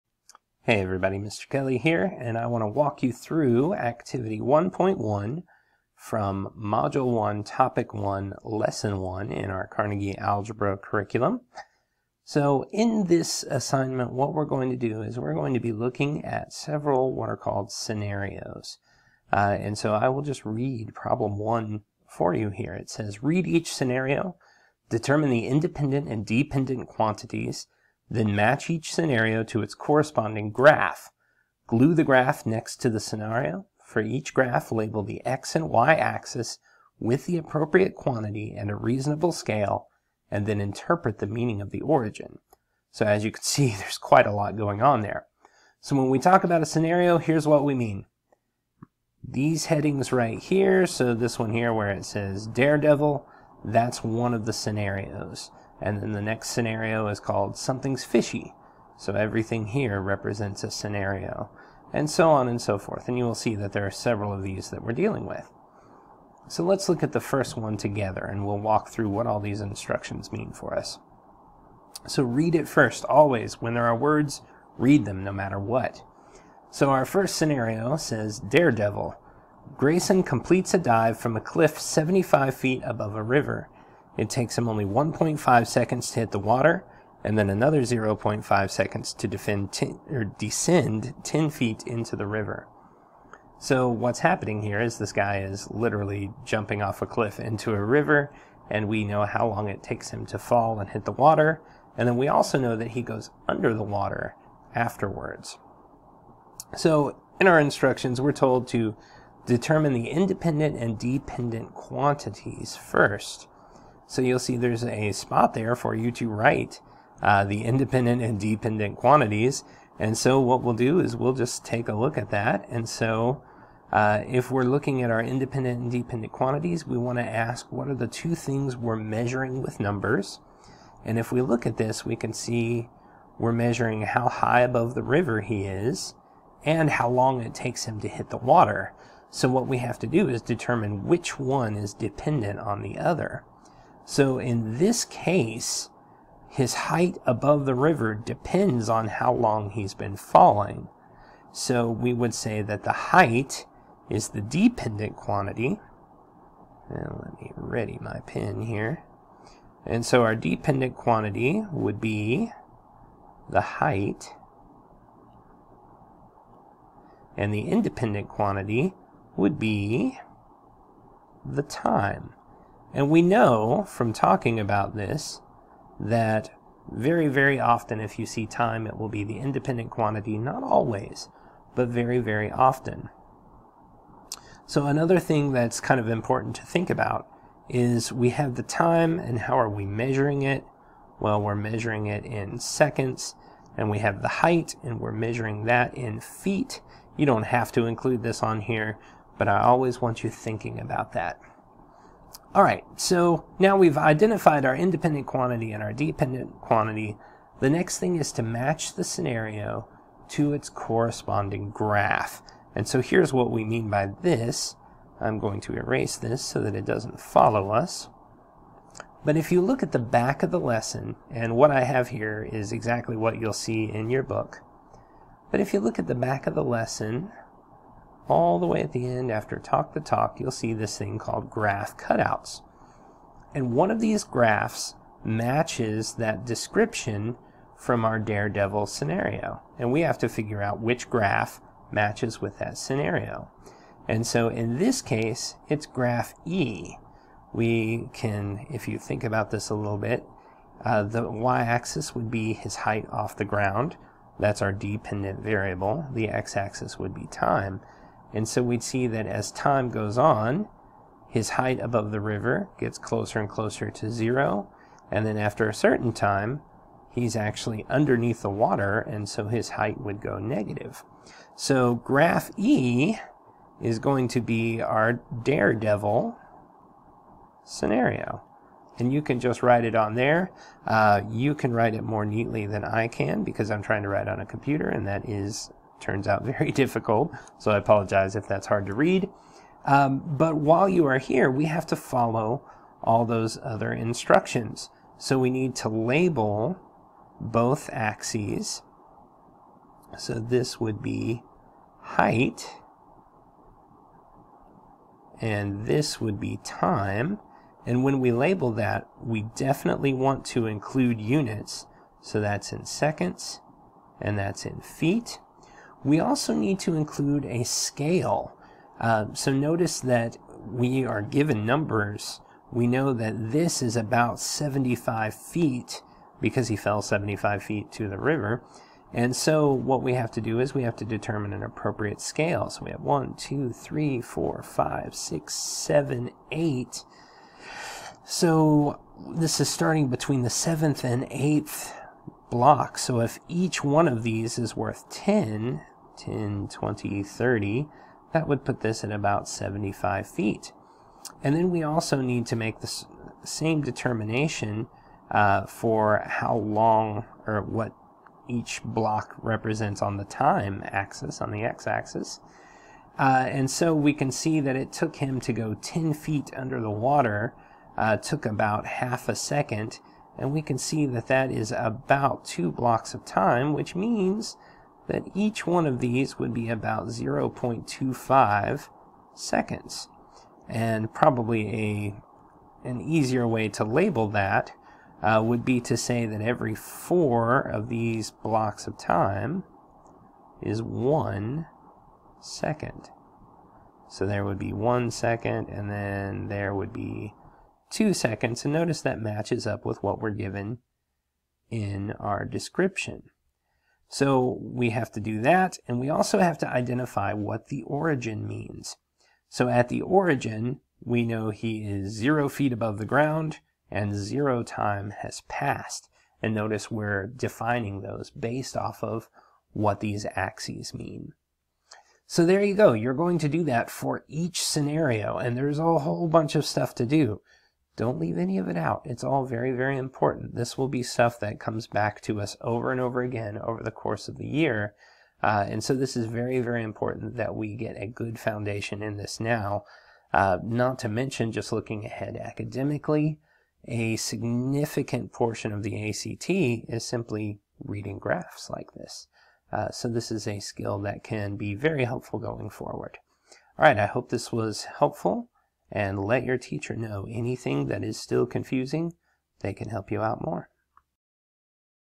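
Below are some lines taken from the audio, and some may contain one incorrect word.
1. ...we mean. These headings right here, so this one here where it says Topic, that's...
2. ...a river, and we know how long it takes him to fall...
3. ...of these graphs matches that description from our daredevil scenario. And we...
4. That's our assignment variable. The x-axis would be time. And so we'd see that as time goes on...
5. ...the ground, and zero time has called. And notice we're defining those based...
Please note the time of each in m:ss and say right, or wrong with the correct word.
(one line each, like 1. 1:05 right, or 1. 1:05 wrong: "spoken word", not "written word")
1. 0:47 wrong: "Daredevil", not "Topic"
2. 1:37 right
3. 3:53 right
4. 4:14 wrong: "dependent", not "assignment"
5. 6:52 wrong: "passed", not "called".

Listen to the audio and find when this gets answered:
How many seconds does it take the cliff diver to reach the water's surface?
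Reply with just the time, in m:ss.
1:24.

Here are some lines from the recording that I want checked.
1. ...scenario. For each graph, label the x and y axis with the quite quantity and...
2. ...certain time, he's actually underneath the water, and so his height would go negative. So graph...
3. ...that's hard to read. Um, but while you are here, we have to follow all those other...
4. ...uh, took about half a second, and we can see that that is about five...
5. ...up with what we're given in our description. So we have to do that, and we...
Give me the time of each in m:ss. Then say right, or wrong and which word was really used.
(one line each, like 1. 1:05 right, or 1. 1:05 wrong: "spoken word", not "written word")
1. 0:32 wrong: "appropriate", not "quite"
2. 4:25 right
3. 4:48 right
4. 6:07 wrong: "two", not "five"
5. 6:39 right.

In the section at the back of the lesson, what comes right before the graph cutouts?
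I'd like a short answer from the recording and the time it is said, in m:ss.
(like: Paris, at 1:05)
Talk the talk, at 3:49.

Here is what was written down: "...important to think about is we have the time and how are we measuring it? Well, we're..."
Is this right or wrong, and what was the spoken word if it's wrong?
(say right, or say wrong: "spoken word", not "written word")
right.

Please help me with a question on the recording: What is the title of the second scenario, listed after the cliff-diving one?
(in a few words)
Something's fishy.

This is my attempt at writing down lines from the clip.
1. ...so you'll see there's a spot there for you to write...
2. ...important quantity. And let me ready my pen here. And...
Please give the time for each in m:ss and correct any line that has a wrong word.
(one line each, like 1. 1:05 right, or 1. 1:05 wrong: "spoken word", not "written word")
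1. 1:54 right
2. 2:34 wrong: "dependent", not "important".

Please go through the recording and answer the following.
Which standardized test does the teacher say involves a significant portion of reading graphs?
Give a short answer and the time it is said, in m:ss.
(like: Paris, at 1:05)
ACT, at 7:26.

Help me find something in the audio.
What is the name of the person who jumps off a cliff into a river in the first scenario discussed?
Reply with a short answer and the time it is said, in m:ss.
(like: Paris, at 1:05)
Grayson, at 1:19.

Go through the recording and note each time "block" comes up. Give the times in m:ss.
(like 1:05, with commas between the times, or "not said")
5:42, 5:58, 6:12, 6:28.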